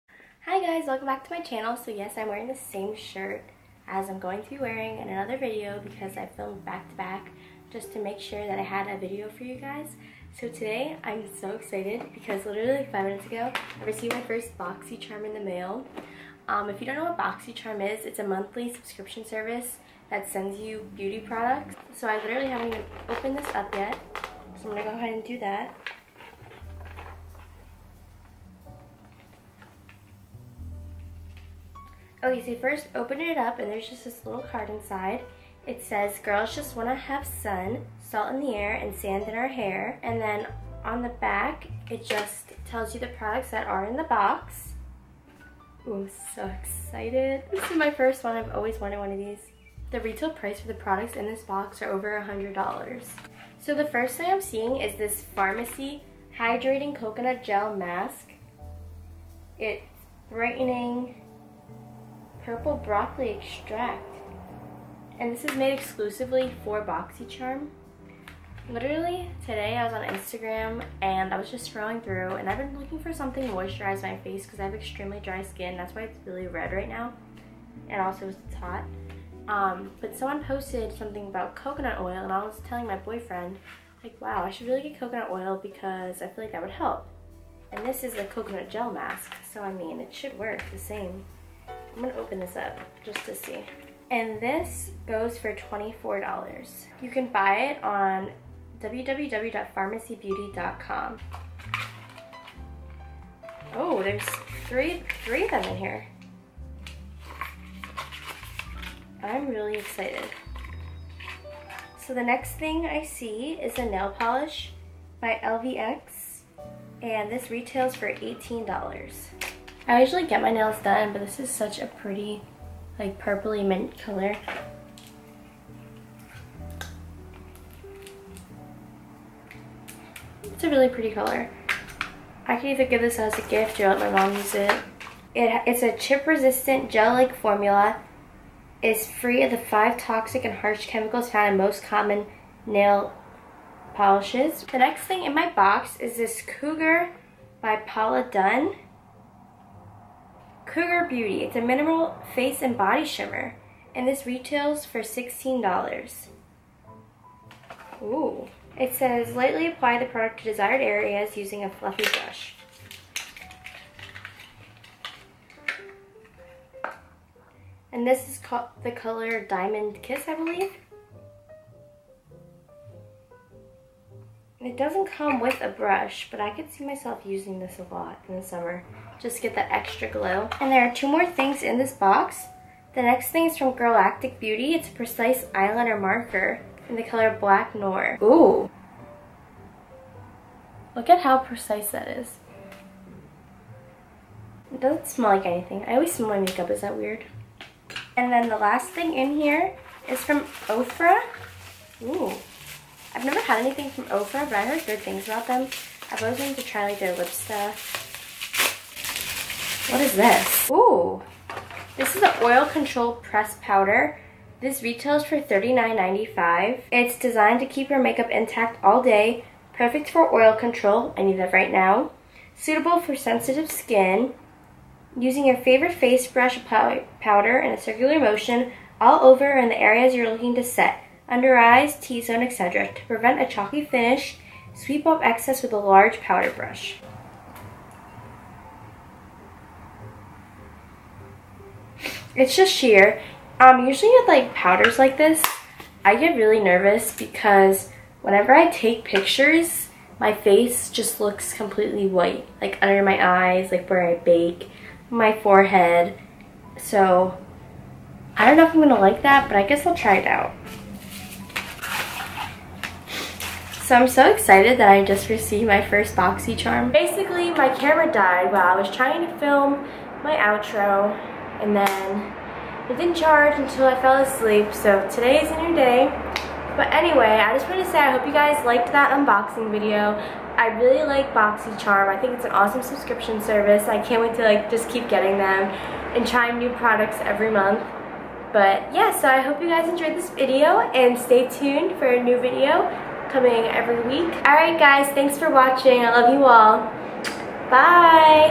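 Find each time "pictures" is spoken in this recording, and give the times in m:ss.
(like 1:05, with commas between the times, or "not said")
4:09.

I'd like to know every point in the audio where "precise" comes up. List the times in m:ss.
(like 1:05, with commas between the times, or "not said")
3:04, 3:11.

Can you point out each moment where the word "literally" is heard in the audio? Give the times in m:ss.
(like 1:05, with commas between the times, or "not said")
0:12, 0:22, 1:08.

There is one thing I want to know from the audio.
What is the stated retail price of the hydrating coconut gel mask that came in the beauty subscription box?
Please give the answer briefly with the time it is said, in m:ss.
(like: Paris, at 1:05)
$24, at 1:35.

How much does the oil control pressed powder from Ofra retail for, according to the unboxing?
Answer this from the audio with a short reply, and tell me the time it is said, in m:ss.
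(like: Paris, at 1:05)
$39.95, at 3:35.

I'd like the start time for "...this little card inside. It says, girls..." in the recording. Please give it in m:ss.
0:34.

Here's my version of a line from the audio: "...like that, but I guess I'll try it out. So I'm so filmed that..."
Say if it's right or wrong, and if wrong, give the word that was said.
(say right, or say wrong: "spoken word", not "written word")
wrong: "excited", not "filmed".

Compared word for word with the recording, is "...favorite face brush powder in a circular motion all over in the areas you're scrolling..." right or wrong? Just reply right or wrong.
wrong.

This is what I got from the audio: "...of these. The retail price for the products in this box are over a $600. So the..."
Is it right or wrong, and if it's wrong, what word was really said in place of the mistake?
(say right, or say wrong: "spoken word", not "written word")
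wrong: "100", not "600".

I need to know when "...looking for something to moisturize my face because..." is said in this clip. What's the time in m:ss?
1:12.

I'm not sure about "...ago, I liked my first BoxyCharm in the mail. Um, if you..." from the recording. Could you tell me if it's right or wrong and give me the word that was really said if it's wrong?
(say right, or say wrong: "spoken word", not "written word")
wrong: "received", not "liked".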